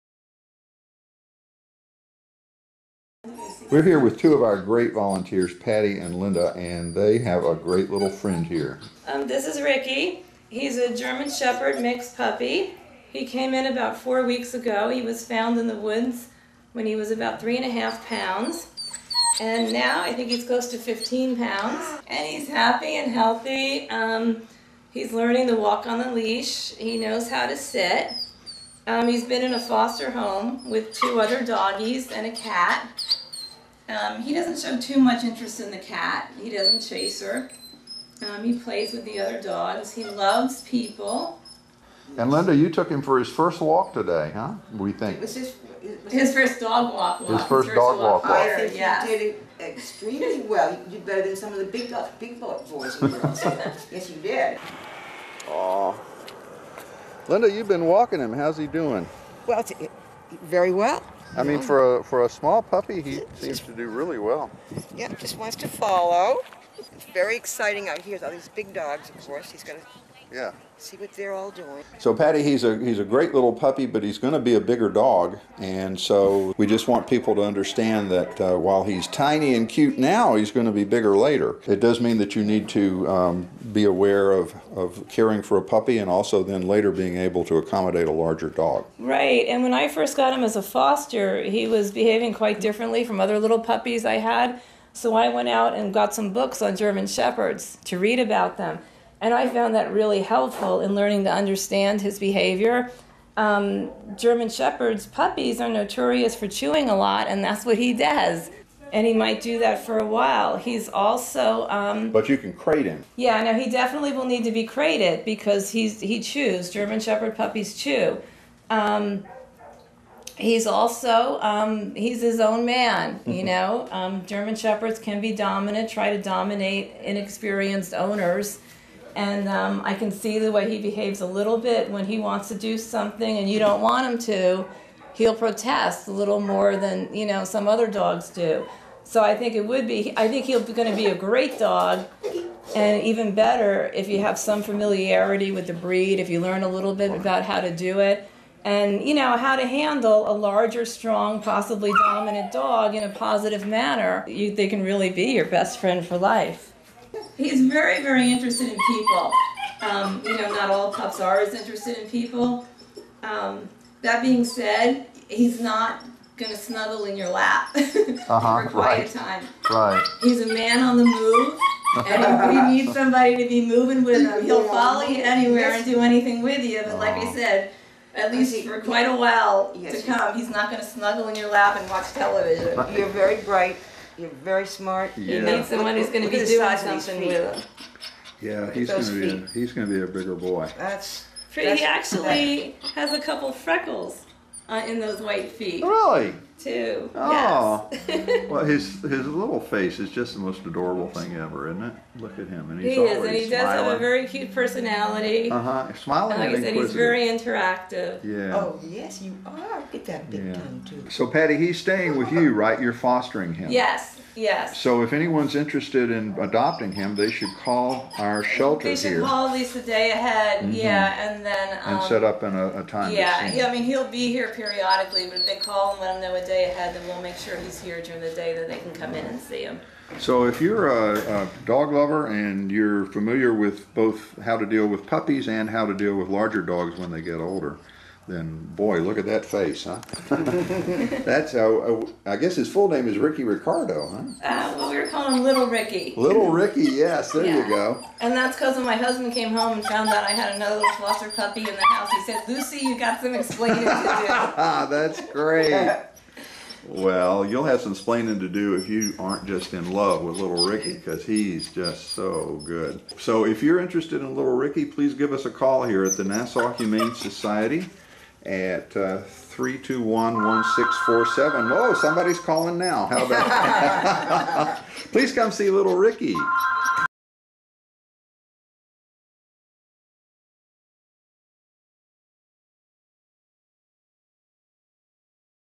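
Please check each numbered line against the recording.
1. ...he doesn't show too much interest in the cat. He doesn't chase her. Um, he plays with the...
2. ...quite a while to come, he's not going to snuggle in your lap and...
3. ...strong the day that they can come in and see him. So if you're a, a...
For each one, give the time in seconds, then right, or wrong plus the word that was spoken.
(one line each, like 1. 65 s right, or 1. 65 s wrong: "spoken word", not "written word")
1. 34 s right
2. 178 s right
3. 228 s wrong: "during", not "strong".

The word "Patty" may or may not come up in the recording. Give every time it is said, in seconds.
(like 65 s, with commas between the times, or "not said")
5 s, 72 s, 211 s.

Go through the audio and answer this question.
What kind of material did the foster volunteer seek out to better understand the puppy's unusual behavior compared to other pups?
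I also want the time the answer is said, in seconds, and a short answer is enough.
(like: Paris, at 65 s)
Books on German Shepherds, at 96 s.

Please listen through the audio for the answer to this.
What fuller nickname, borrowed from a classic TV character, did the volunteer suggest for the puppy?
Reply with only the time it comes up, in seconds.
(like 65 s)
243 s.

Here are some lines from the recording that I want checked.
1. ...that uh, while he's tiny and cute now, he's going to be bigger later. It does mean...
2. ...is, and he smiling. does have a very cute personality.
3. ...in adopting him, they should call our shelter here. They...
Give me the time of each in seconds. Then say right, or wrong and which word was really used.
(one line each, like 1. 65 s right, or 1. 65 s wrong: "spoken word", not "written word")
1. 78 s right
2. 203 s right
3. 216 s right.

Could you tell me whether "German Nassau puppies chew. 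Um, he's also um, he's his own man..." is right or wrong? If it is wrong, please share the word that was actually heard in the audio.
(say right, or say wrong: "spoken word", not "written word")
wrong: "Shepherd", not "Nassau".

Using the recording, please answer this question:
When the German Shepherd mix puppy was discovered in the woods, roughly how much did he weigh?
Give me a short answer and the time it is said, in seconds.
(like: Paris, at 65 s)
3.5 pounds, at 17 s.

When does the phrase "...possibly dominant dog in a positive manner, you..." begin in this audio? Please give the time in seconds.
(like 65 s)
151 s.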